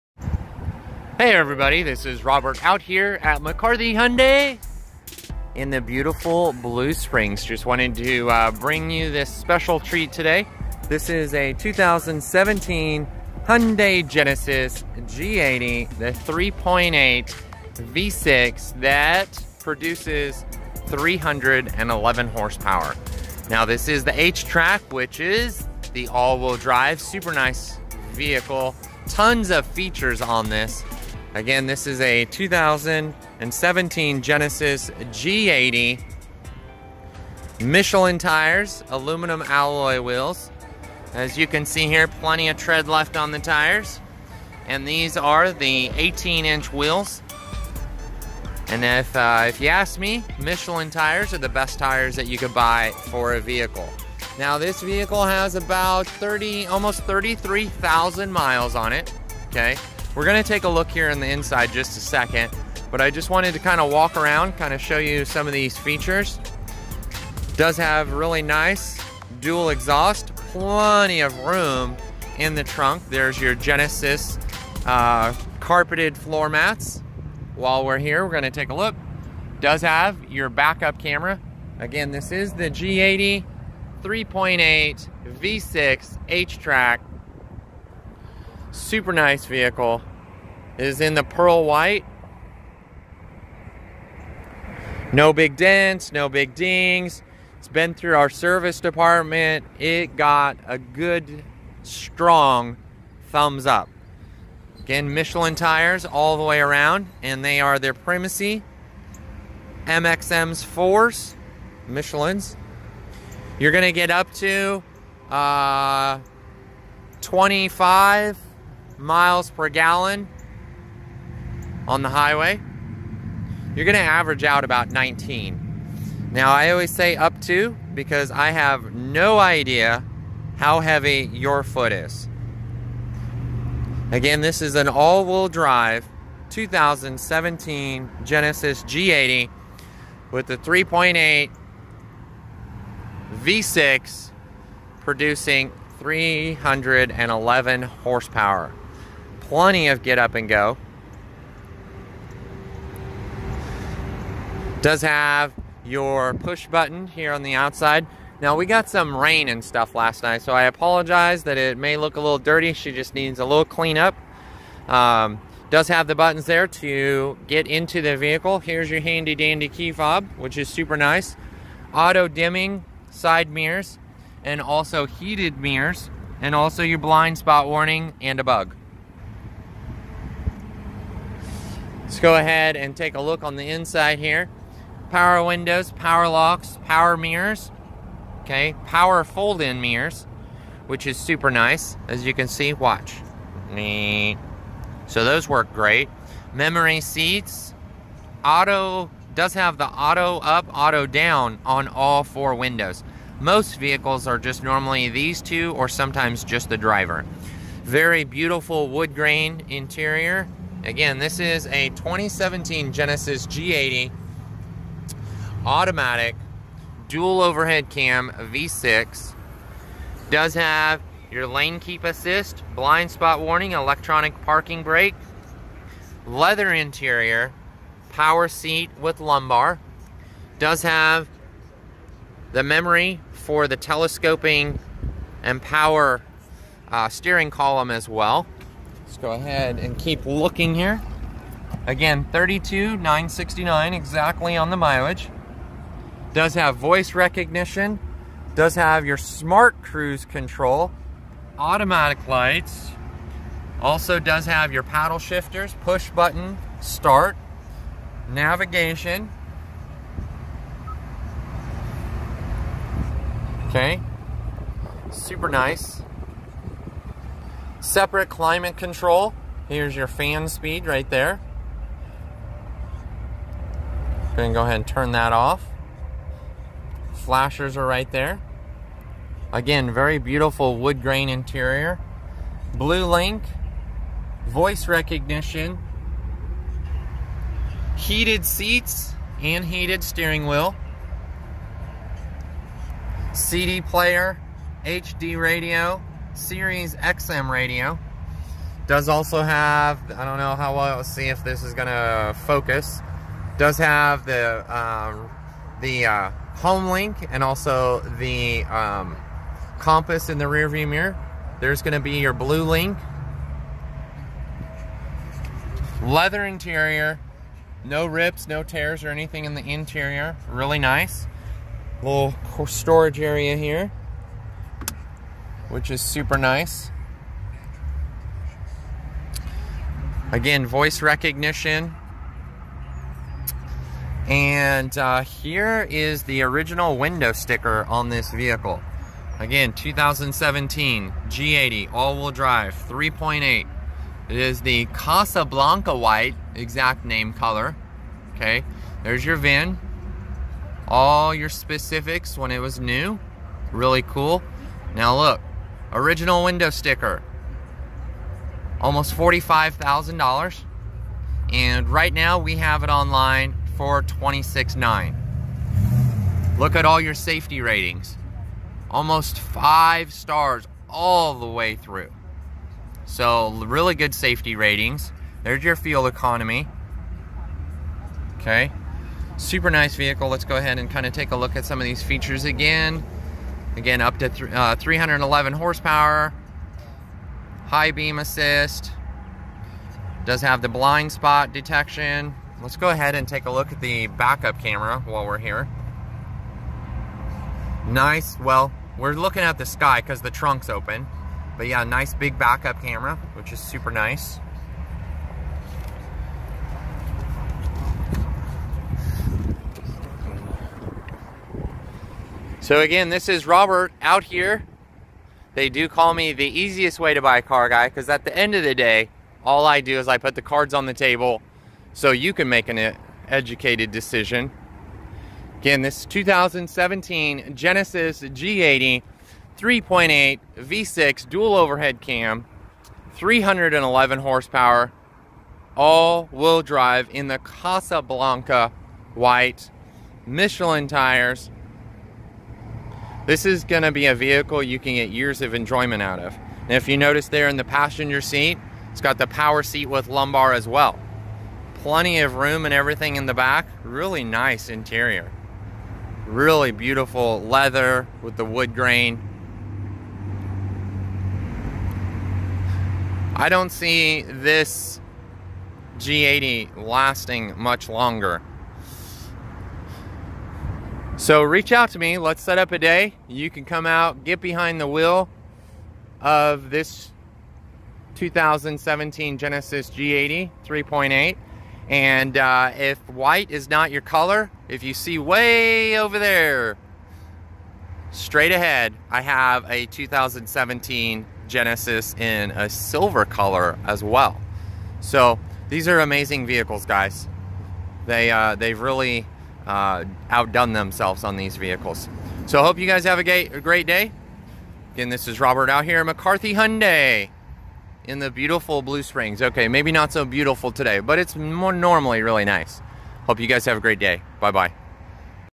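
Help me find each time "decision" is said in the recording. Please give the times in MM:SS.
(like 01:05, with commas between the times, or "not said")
07:03.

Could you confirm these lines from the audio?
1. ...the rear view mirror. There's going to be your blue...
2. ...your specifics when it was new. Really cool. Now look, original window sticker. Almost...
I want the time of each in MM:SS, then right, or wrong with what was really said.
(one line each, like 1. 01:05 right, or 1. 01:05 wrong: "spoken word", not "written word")
1. 05:10 right
2. 05:51 right.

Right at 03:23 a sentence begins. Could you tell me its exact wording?
Most vehicles are just normally these two or sometimes just the driver.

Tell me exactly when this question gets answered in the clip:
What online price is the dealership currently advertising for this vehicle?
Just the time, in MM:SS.
06:04.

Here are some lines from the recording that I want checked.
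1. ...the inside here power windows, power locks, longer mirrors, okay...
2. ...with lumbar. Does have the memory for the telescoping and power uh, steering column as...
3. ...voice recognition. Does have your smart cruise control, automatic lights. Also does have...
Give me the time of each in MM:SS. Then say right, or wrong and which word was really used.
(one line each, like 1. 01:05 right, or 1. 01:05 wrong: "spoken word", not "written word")
1. 03:03 wrong: "power", not "longer"
2. 03:48 right
3. 04:06 right.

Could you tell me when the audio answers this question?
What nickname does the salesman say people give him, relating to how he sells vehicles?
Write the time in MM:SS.
06:56.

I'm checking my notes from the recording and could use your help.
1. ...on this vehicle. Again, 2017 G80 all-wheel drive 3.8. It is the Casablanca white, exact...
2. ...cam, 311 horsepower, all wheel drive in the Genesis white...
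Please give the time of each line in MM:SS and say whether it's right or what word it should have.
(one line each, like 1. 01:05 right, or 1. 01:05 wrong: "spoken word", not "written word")
1. 05:37 right
2. 07:12 wrong: "Casablanca", not "Genesis".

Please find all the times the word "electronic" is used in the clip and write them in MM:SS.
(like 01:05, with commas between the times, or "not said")
03:43.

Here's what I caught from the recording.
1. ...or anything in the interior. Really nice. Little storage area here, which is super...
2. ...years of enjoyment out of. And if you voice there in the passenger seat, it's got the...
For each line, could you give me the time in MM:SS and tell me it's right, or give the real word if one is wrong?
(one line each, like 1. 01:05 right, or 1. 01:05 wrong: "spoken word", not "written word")
1. 05:19 right
2. 07:25 wrong: "notice", not "voice".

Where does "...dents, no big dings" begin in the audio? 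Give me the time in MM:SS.
01:35.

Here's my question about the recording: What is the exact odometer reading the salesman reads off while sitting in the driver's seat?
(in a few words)
32,969.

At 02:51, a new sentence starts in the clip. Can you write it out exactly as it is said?
Auto dimming side mirrors and also heated mirrors and also your blind spot warning and a bug.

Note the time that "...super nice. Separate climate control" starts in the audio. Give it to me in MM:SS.
04:25.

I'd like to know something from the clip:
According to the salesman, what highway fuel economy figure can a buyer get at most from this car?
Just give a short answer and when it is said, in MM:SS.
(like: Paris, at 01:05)
25 miles per gallon, at 01:57.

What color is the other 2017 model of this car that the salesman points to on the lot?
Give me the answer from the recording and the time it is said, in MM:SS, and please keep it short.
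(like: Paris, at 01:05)
silver, at 08:12.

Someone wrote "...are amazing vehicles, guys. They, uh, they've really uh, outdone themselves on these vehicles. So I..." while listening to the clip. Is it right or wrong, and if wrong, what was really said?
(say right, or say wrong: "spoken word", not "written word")
right.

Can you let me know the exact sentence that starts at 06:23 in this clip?
Again, up to th uh, 311 horsepower.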